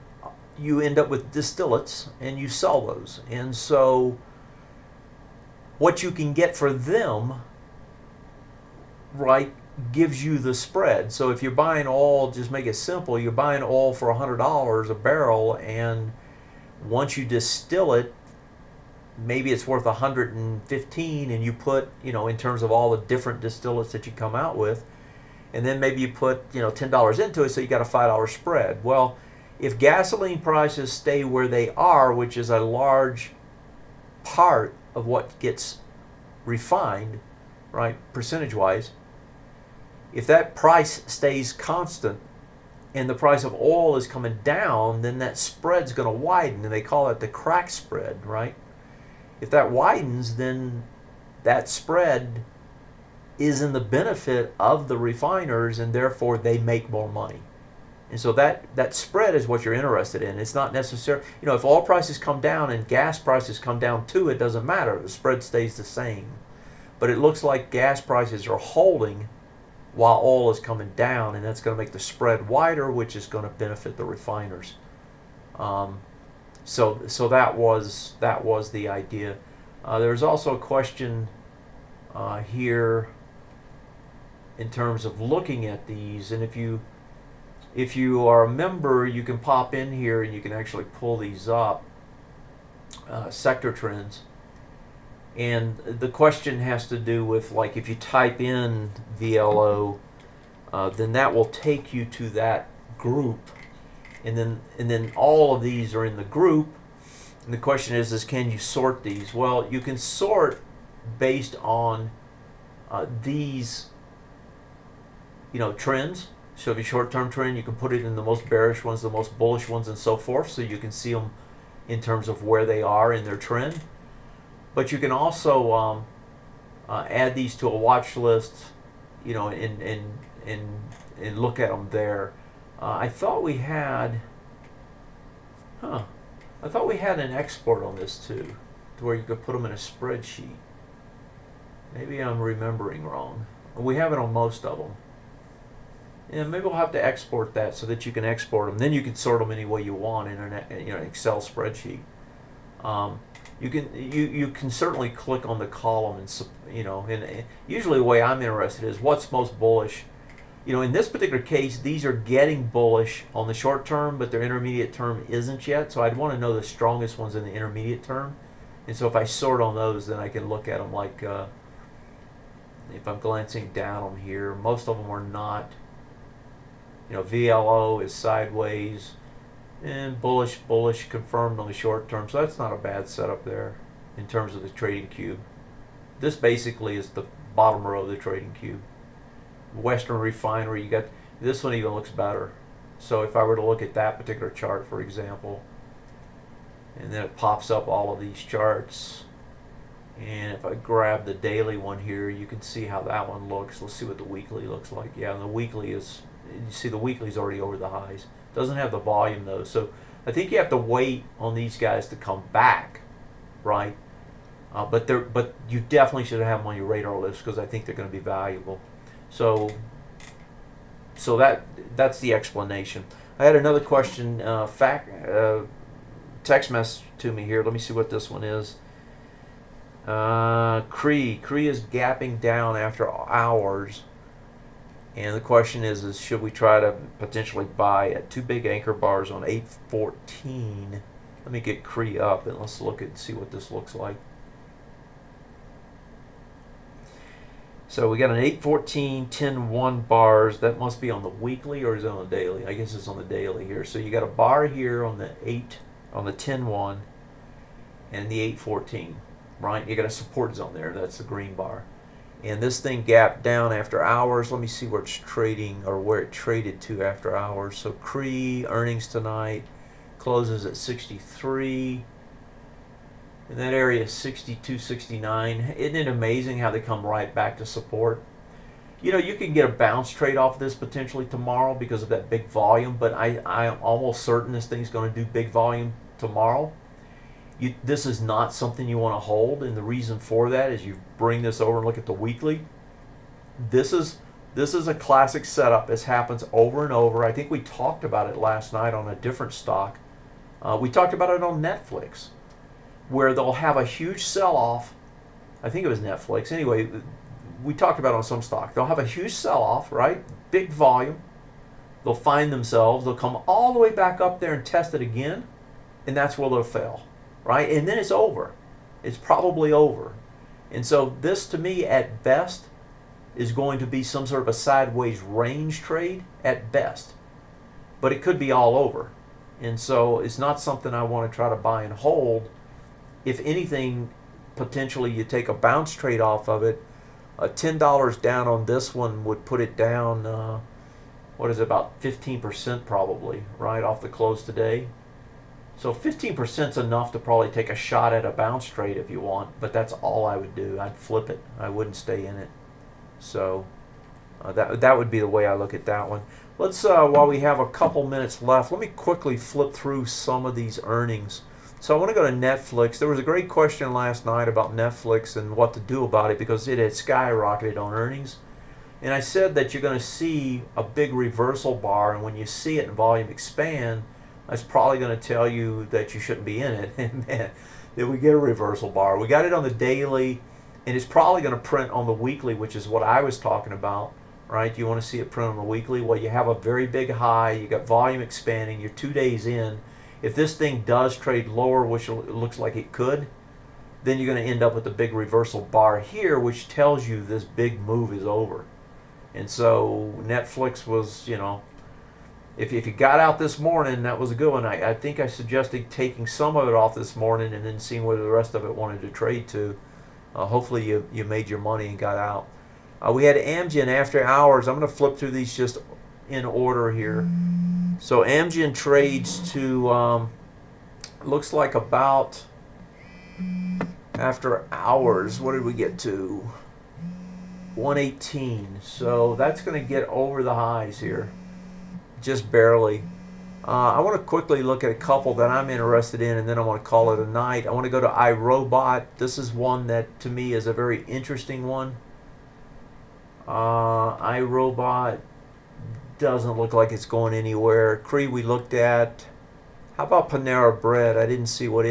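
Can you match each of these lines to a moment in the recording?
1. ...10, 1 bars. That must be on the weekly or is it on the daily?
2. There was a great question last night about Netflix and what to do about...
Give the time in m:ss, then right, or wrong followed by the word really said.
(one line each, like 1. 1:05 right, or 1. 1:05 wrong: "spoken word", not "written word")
1. 4:09 right
2. 6:02 right.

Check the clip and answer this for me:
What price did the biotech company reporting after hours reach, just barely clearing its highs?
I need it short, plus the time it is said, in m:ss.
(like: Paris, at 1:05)
118, at 7:07.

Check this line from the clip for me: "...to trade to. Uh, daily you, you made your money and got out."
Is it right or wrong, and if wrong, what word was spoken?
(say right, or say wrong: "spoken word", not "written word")
wrong: "hopefully", not "daily".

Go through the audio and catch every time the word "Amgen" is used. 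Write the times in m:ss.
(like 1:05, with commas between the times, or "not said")
6:53, 6:58.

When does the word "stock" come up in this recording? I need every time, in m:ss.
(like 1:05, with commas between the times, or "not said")
4:59, 5:08.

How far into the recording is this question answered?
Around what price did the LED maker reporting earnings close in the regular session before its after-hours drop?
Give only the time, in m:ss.
4:30.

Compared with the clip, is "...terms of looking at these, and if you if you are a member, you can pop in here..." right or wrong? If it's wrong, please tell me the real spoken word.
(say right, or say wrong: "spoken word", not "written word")
right.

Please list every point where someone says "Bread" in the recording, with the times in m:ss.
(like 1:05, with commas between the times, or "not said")
7:30.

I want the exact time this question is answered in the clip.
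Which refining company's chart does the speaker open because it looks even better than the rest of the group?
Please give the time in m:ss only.
3:09.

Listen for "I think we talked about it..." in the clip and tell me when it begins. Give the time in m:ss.
4:57.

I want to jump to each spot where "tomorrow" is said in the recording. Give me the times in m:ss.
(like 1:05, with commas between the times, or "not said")
4:41, 4:46.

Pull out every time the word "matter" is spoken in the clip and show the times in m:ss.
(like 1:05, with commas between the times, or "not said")
1:04.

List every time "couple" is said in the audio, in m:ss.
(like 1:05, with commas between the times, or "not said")
5:57, 7:14.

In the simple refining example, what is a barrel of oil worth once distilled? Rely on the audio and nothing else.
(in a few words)
115.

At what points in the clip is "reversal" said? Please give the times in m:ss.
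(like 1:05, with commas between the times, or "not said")
6:11, 6:18, 6:35.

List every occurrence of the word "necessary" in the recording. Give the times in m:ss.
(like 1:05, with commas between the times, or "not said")
1:00.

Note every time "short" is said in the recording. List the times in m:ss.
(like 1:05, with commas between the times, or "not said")
1:56, 2:43, 3:01.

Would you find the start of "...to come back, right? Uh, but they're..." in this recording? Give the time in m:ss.
3:32.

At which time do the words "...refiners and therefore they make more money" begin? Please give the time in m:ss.
0:54.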